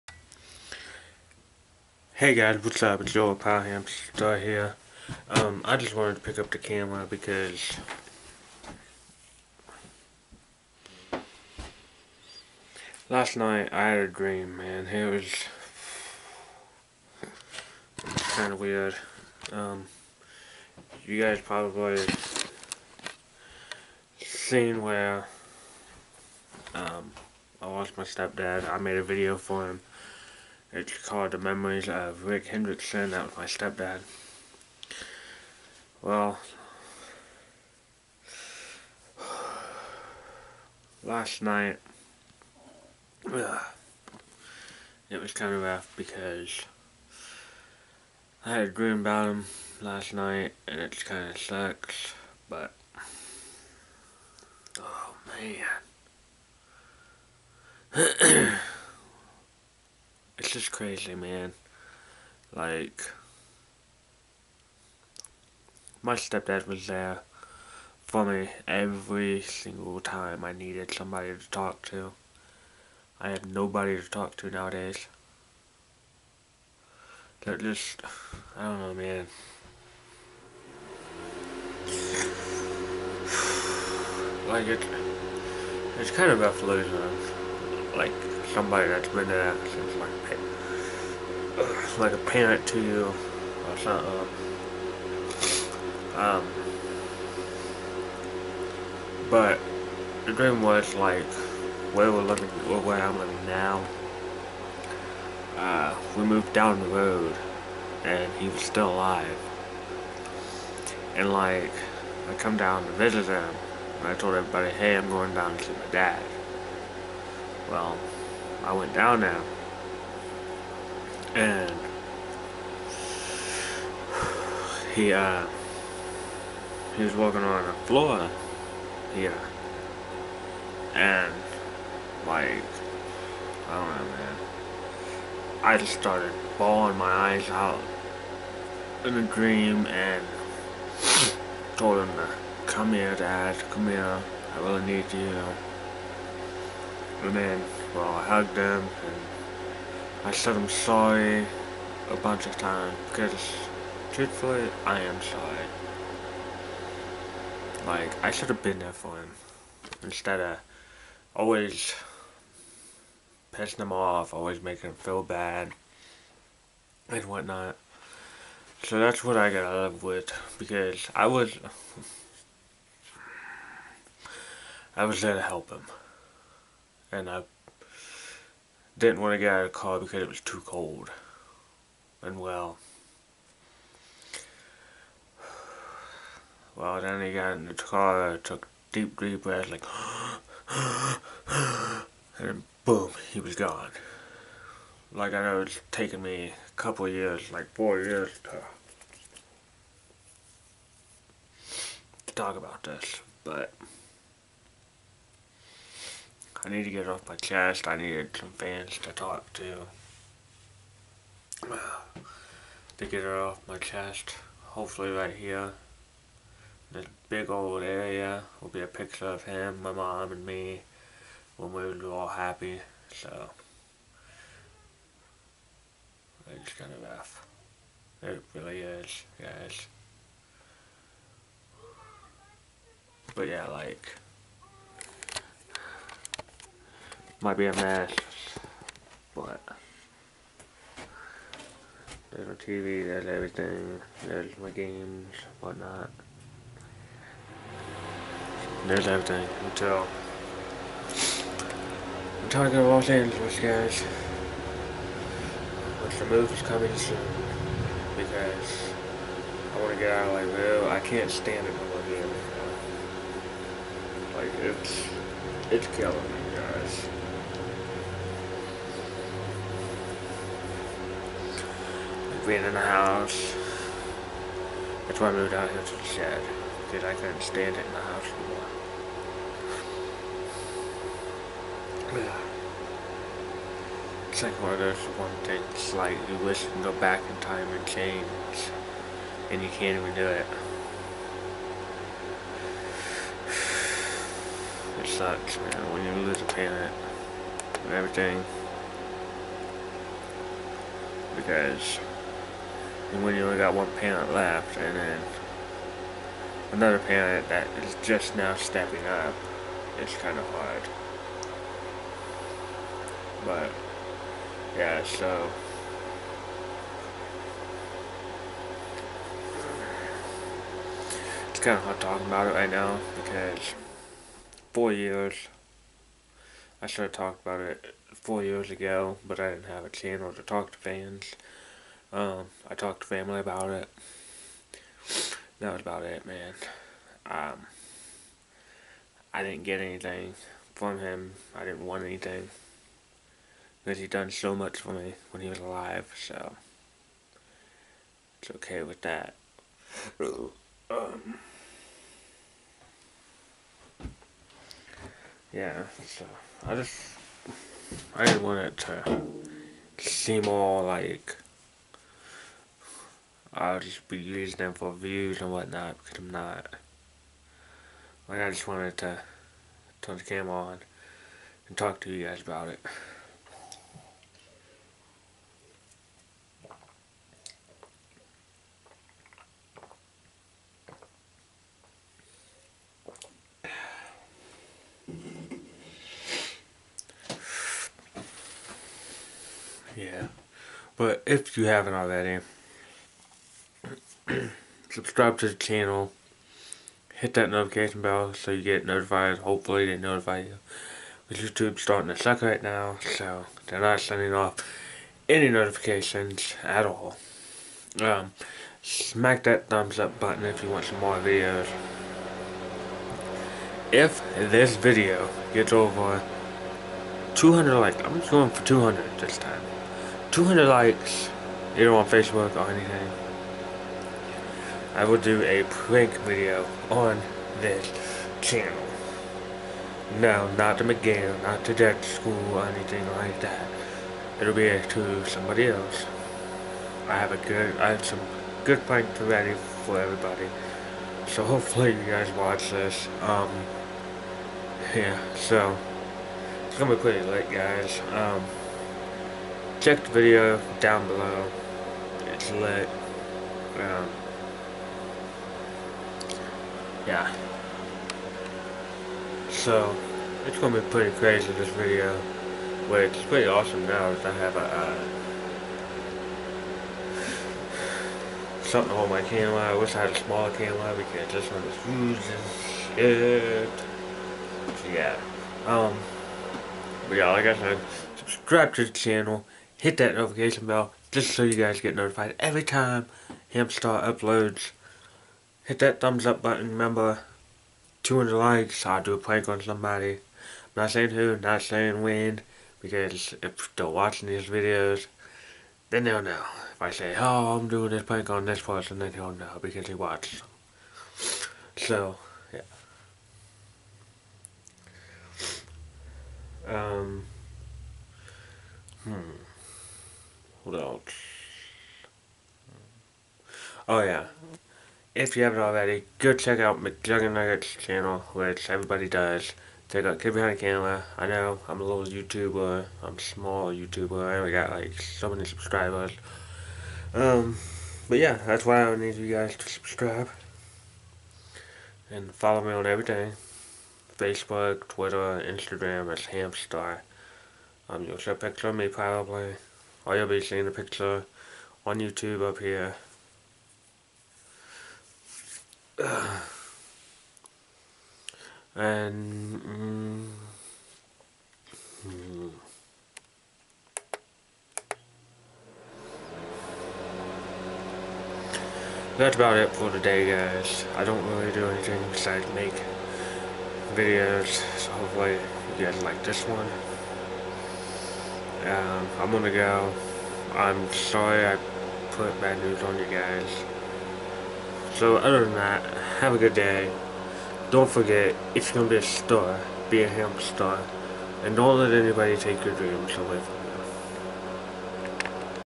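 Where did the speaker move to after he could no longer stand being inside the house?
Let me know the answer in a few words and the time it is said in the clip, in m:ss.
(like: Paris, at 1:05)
the shed, at 4:35.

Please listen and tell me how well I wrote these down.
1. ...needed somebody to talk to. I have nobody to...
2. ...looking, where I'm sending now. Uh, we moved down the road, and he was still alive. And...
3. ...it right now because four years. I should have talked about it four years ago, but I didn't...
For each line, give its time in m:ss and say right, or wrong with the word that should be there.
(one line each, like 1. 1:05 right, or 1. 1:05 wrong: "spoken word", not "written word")
1. 1:10 right
2. 1:42 wrong: "living", not "sending"
3. 5:22 right.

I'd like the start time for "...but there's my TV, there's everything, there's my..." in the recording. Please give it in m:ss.
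3:59.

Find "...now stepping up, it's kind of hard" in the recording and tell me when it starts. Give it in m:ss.
5:08.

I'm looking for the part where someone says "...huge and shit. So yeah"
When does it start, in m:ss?
7:51.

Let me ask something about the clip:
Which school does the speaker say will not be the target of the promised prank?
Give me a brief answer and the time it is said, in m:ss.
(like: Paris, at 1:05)
McGill, at 7:10.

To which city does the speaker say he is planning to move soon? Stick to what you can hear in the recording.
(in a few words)
Los Angeles.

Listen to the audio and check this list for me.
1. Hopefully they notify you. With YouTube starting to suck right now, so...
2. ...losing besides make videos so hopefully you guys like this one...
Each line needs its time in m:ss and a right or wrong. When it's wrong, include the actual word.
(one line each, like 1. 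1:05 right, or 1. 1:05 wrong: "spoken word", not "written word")
1. 6:39 right
2. 9:21 wrong: "anything", not "losing".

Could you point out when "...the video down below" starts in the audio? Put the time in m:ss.
7:30.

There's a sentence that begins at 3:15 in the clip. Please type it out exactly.
Like I know it's taken me a couple years, like four years to talk about this, but.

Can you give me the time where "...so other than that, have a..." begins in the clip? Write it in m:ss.
9:35.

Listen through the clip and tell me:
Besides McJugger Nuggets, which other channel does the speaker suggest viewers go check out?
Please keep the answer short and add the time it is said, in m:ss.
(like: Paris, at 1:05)
Kid Behind the Camera, at 8:40.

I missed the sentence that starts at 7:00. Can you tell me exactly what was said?
200 likes, either on Facebook or anything.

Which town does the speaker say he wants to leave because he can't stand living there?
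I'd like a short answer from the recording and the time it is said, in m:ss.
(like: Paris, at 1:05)
Lakeville, at 4:20.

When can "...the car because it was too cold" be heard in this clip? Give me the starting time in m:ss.
2:59.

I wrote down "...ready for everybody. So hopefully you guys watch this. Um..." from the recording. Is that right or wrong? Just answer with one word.
right.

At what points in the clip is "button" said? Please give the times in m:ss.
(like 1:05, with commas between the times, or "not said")
6:50, 8:06.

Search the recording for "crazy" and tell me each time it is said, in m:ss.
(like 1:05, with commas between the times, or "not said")
1:00, 7:41.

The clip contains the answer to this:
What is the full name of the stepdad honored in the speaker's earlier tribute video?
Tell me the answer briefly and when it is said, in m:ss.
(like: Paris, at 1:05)
Rick Hendrickson, at 0:32.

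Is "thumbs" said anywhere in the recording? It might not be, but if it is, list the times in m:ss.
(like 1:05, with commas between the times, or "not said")
6:49, 8:05.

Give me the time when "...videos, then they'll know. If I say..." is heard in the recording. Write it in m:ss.
8:14.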